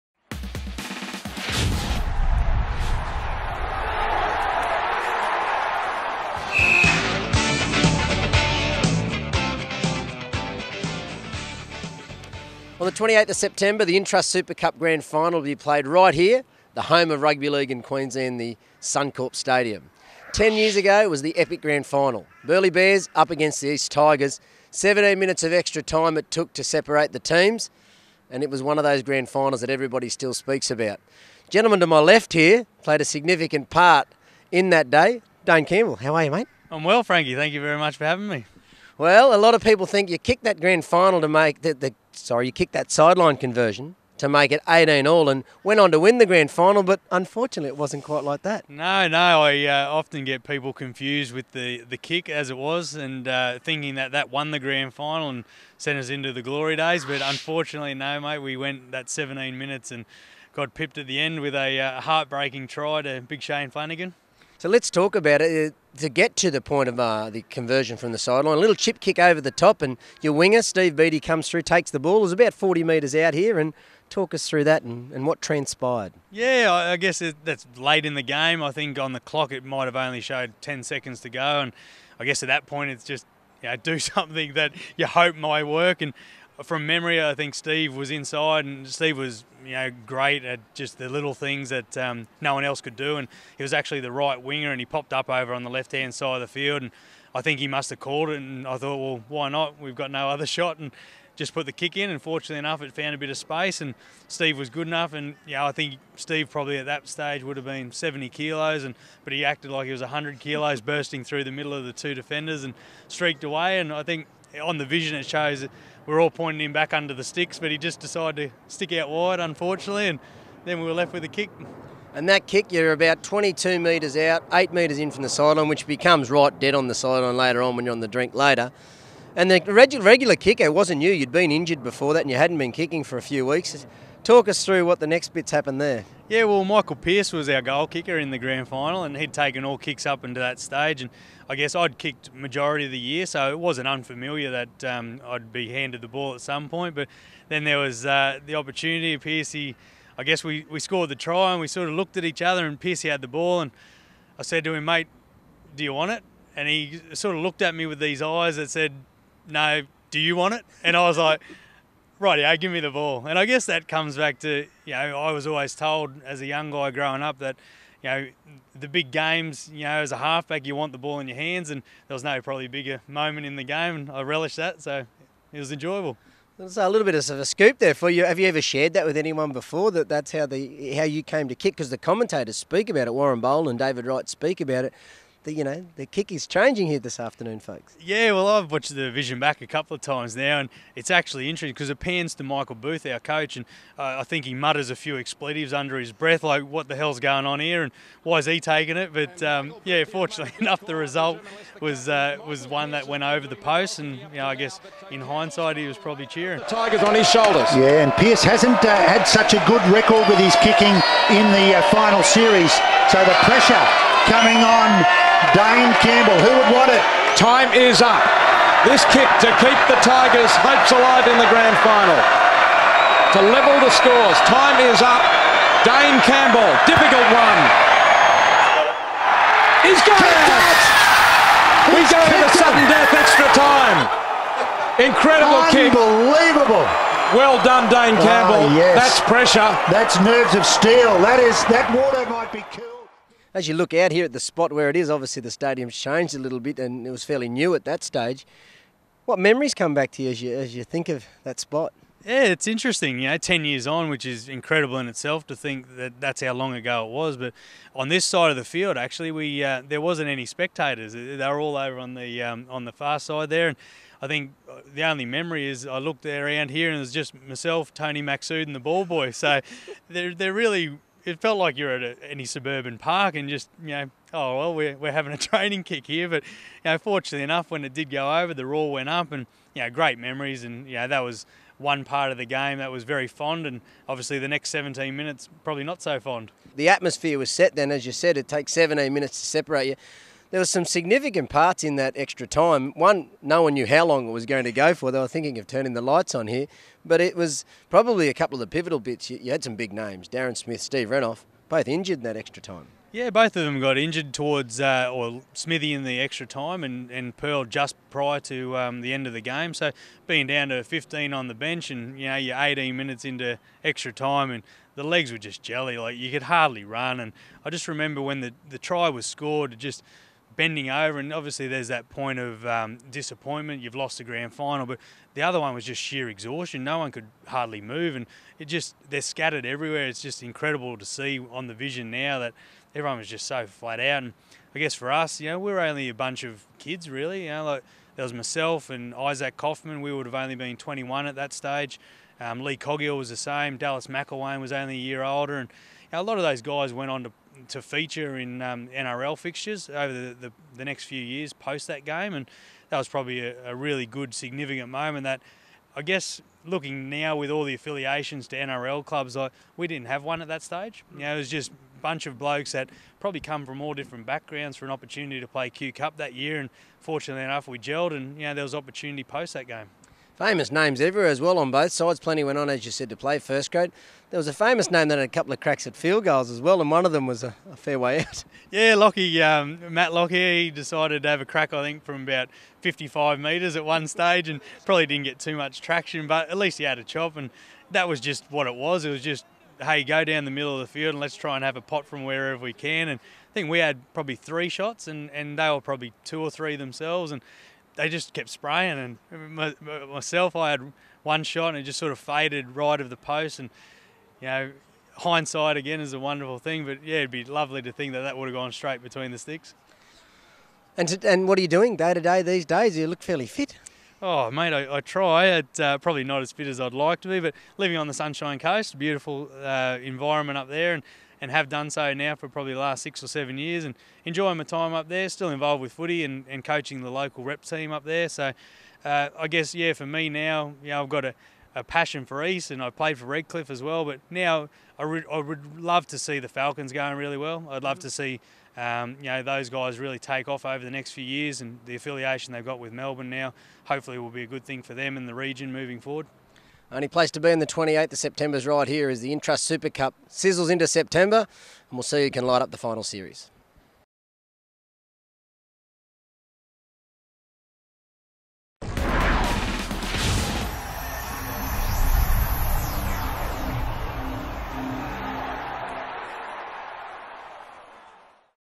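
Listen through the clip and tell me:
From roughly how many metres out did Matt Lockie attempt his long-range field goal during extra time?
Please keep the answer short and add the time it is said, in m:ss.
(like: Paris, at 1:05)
55 metres, at 6:22.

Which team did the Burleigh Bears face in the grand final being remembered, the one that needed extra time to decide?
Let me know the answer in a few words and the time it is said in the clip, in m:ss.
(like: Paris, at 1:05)
East Tigers, at 0:23.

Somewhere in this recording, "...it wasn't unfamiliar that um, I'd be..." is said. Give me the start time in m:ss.
2:23.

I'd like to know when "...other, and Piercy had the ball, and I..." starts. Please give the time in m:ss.
2:32.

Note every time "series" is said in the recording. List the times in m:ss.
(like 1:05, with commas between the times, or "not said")
3:32, 7:33.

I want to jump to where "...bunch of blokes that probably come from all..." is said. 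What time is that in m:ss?
6:02.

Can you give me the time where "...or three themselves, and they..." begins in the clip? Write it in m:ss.
6:36.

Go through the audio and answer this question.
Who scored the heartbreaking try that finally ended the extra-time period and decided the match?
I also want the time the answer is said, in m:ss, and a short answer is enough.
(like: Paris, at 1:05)
Shane Flanagan, at 1:03.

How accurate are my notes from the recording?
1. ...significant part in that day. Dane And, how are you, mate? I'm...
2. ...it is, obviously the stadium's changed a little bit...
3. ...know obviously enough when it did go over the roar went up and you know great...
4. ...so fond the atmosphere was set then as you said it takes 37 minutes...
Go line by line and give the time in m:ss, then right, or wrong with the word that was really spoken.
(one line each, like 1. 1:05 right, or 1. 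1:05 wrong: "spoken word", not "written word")
1. 0:33 wrong: "Campbell", not "And"
2. 4:04 right
3. 4:36 wrong: "fortunately", not "obviously"
4. 4:46 wrong: "17", not "37".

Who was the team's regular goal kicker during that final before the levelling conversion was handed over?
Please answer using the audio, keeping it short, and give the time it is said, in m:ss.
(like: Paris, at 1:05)
Michael Pierce, at 2:16.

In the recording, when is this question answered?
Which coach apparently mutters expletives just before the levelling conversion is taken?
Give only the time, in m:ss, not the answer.
3:12.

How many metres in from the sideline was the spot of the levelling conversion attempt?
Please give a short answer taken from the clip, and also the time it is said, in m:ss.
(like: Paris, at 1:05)
8 metres, at 2:04.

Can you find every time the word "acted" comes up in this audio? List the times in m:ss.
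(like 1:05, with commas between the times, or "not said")
1:49.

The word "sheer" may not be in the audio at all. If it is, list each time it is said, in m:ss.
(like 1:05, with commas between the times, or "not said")
5:26.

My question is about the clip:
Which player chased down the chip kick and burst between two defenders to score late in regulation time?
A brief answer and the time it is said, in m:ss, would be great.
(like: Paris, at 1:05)
Steve Beattie, at 1:10.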